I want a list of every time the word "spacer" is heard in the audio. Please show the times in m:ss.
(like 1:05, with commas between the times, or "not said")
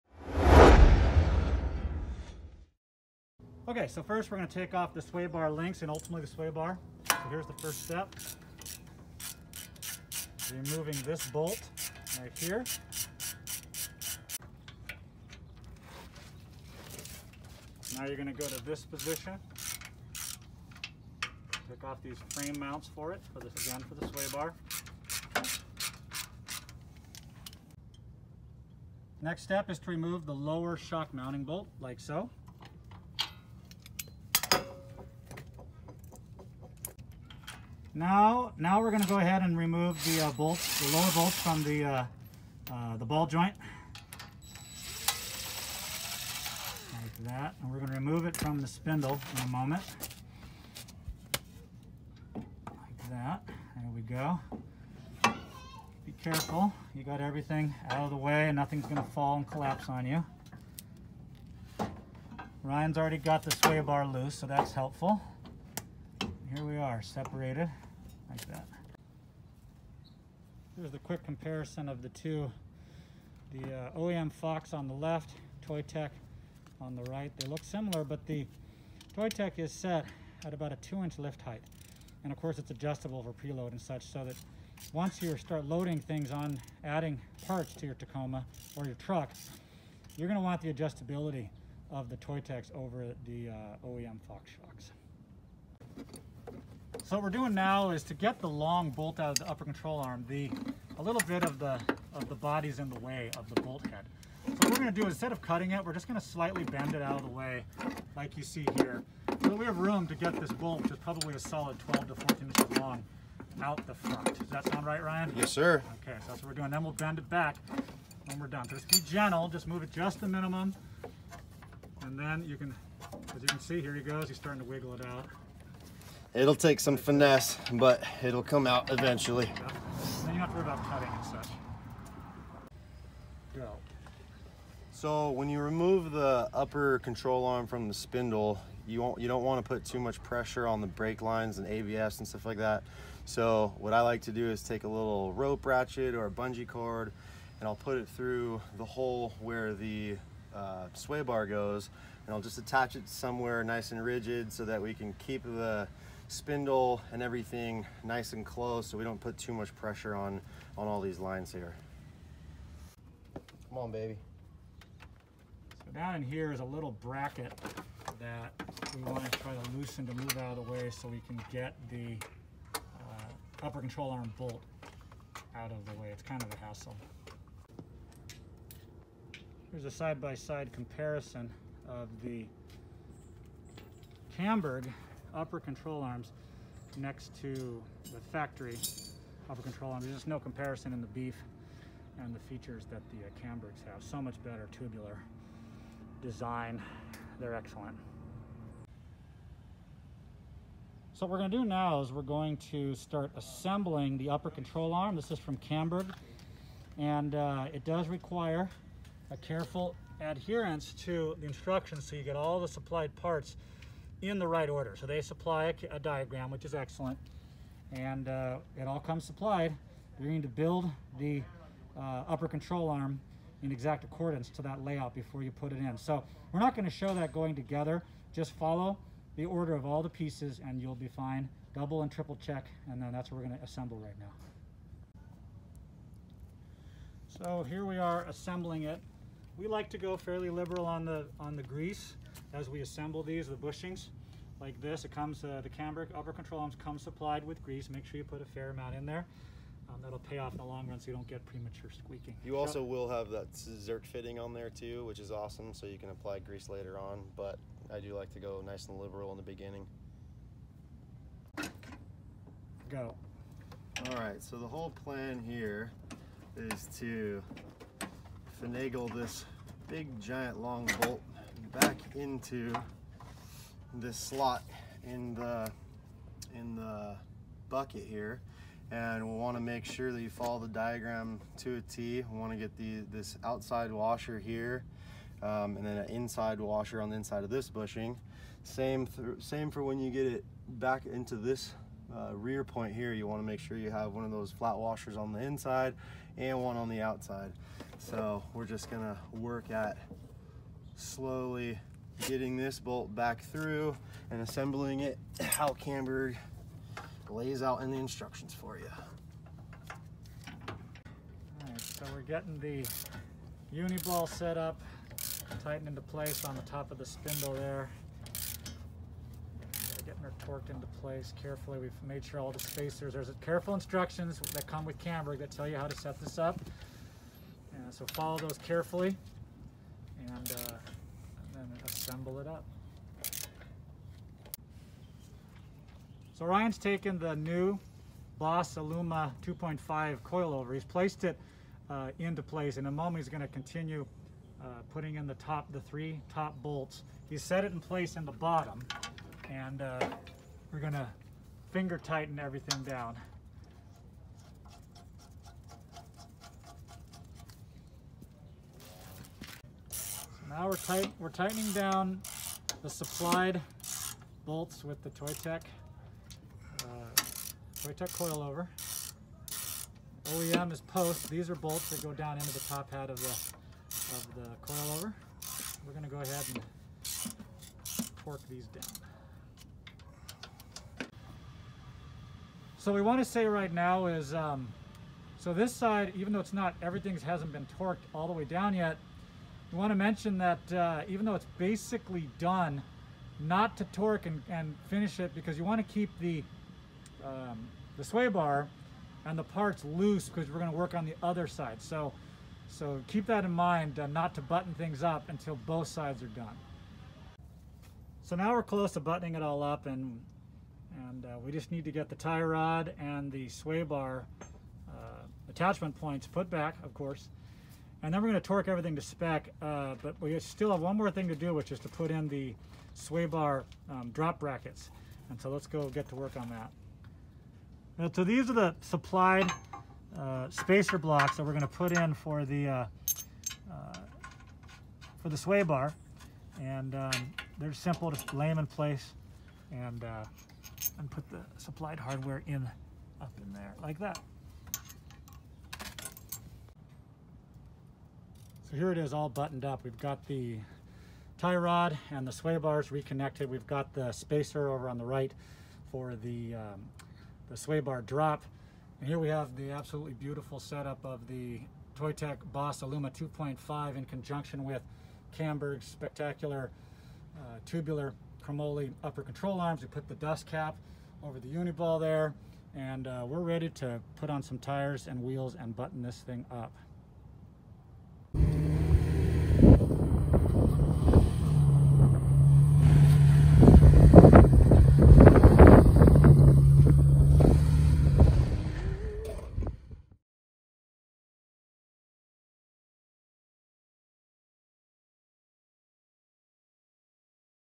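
5:22, 7:10, 7:34.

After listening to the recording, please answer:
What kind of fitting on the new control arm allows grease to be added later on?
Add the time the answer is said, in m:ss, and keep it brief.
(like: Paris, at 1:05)
zerk fitting, at 4:13.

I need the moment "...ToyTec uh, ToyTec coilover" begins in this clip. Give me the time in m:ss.
6:05.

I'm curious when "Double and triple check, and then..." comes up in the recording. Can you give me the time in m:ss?
3:51.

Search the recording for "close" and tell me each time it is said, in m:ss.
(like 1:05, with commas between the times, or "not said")
2:38, 6:48.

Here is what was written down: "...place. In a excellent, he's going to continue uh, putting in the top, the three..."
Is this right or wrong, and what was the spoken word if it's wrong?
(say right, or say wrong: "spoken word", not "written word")
wrong: "moment", not "excellent".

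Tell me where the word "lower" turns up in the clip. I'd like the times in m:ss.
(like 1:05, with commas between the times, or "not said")
0:30, 0:40.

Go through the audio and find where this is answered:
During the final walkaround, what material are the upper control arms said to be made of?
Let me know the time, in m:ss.
7:48.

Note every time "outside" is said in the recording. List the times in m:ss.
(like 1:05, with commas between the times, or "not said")
4:43, 4:57.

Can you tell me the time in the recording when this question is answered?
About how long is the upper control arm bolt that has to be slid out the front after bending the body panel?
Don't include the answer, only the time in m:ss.
1:51.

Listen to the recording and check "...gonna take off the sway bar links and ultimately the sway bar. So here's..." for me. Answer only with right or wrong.
right.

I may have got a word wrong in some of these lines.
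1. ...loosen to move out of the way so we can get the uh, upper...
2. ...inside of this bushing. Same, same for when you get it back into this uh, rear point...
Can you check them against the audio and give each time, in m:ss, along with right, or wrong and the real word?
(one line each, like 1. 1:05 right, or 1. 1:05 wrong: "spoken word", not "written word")
1. 2:49 right
2. 4:47 right.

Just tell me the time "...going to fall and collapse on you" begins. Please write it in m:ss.
0:58.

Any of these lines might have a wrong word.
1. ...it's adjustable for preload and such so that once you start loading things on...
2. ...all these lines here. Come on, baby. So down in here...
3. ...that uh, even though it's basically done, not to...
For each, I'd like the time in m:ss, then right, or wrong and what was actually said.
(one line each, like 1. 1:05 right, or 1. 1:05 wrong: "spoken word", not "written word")
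1. 1:22 right
2. 2:40 right
3. 6:30 right.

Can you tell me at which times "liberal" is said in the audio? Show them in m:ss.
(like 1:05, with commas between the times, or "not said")
4:00, 4:18.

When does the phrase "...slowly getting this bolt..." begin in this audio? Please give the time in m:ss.
5:00.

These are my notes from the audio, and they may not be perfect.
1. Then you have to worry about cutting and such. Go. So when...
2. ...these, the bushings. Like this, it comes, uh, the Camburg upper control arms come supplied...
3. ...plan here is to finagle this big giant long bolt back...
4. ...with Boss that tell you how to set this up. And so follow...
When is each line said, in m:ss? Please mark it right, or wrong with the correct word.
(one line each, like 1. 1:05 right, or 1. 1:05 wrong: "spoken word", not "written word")
1. 2:10 right
2. 4:03 right
3. 4:25 right
4. 5:24 wrong: "Camburg", not "Boss".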